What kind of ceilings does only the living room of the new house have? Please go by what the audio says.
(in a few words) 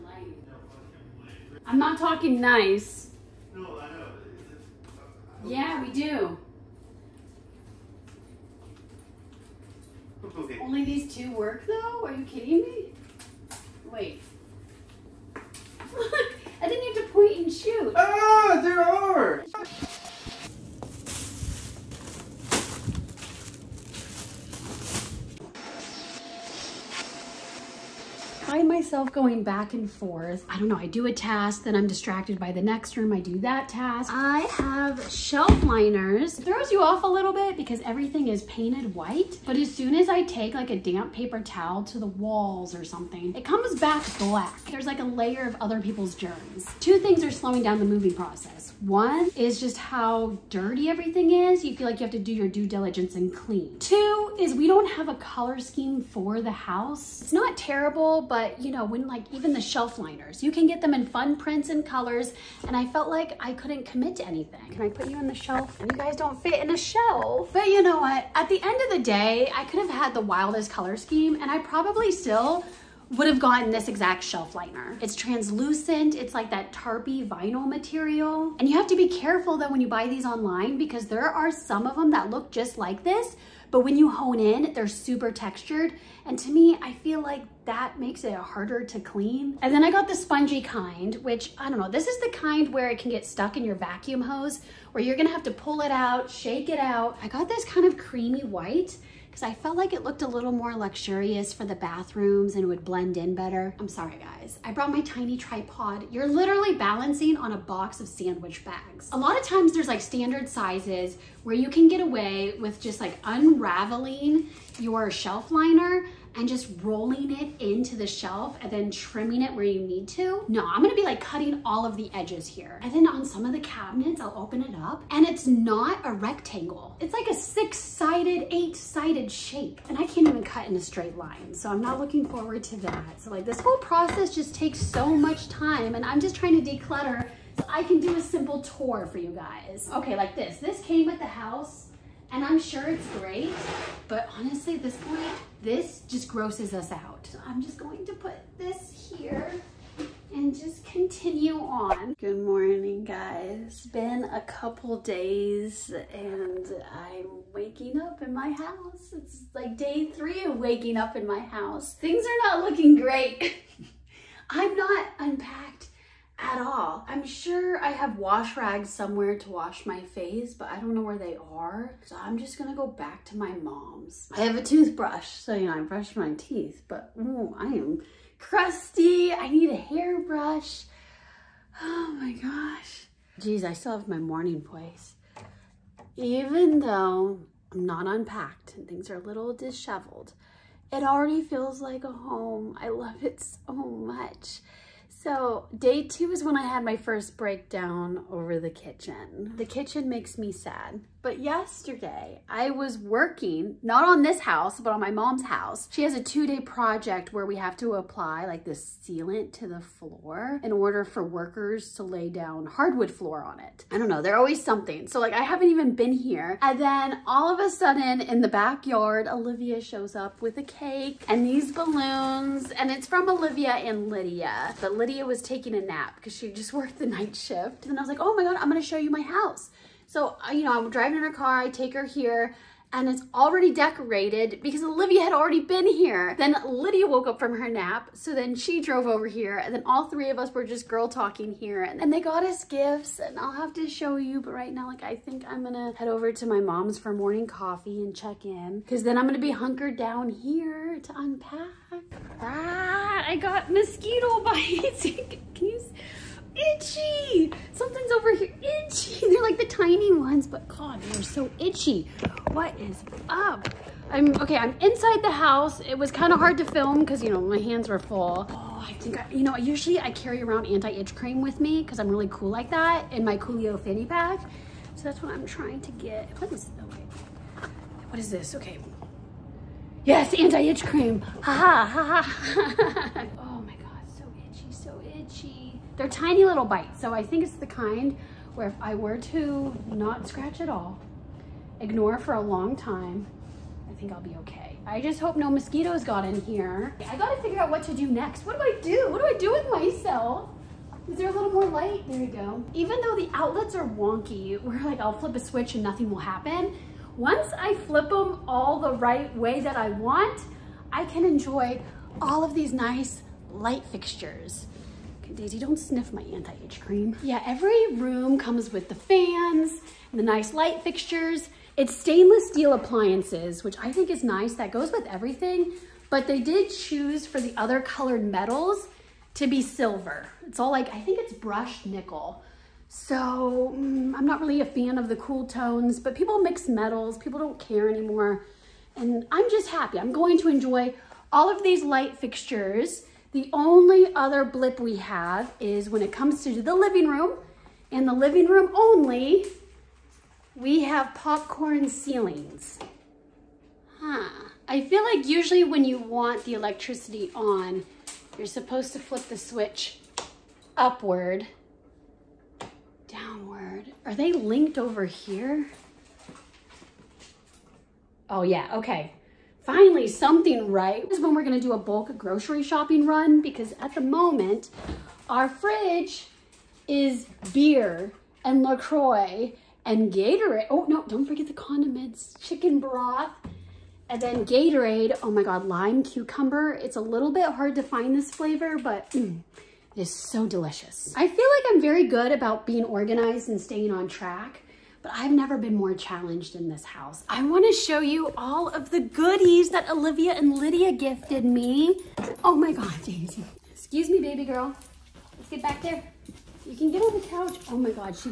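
popcorn ceilings.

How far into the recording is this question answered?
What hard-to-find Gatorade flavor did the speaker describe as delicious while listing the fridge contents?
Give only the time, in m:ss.
6:25.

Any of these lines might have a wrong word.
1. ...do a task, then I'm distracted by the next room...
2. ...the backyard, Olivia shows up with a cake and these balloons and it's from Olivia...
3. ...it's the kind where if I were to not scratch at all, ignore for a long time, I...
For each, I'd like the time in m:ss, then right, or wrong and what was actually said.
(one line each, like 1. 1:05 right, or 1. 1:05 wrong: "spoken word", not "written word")
1. 0:30 right
2. 3:38 right
3. 4:47 right.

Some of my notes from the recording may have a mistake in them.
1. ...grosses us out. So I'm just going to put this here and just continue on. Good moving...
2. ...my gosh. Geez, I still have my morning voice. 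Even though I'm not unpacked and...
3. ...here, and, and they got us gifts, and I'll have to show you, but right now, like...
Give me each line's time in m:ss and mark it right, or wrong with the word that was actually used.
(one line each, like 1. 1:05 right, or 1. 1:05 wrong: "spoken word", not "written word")
1. 2:26 wrong: "morning", not "moving"
2. 3:02 right
3. 4:01 right.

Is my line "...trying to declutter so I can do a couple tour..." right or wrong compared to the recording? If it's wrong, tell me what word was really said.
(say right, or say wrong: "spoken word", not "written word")
wrong: "simple", not "couple".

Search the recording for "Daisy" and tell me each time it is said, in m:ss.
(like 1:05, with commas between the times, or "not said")
5:15, 6:43.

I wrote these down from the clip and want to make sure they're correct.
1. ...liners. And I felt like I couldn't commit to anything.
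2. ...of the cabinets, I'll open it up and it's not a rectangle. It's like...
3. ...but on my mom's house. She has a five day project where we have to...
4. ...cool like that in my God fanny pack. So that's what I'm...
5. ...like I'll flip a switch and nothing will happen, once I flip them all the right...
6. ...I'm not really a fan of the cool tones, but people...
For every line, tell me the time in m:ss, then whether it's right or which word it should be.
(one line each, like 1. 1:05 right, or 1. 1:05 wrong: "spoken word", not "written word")
1. 1:01 wrong: "colors", not "liners"
2. 2:03 right
3. 3:24 wrong: "two", not "five"
4. 4:32 wrong: "Coolio", not "God"
5. 5:04 right
6. 5:34 right.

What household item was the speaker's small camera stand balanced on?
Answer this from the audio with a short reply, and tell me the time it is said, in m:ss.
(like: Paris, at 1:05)
box of sandwich bags, at 1:47.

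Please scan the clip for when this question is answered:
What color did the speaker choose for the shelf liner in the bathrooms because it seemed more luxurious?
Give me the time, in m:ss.
1:37.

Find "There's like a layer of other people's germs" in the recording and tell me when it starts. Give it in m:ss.
0:44.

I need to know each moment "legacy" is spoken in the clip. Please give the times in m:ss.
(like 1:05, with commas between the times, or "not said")
not said.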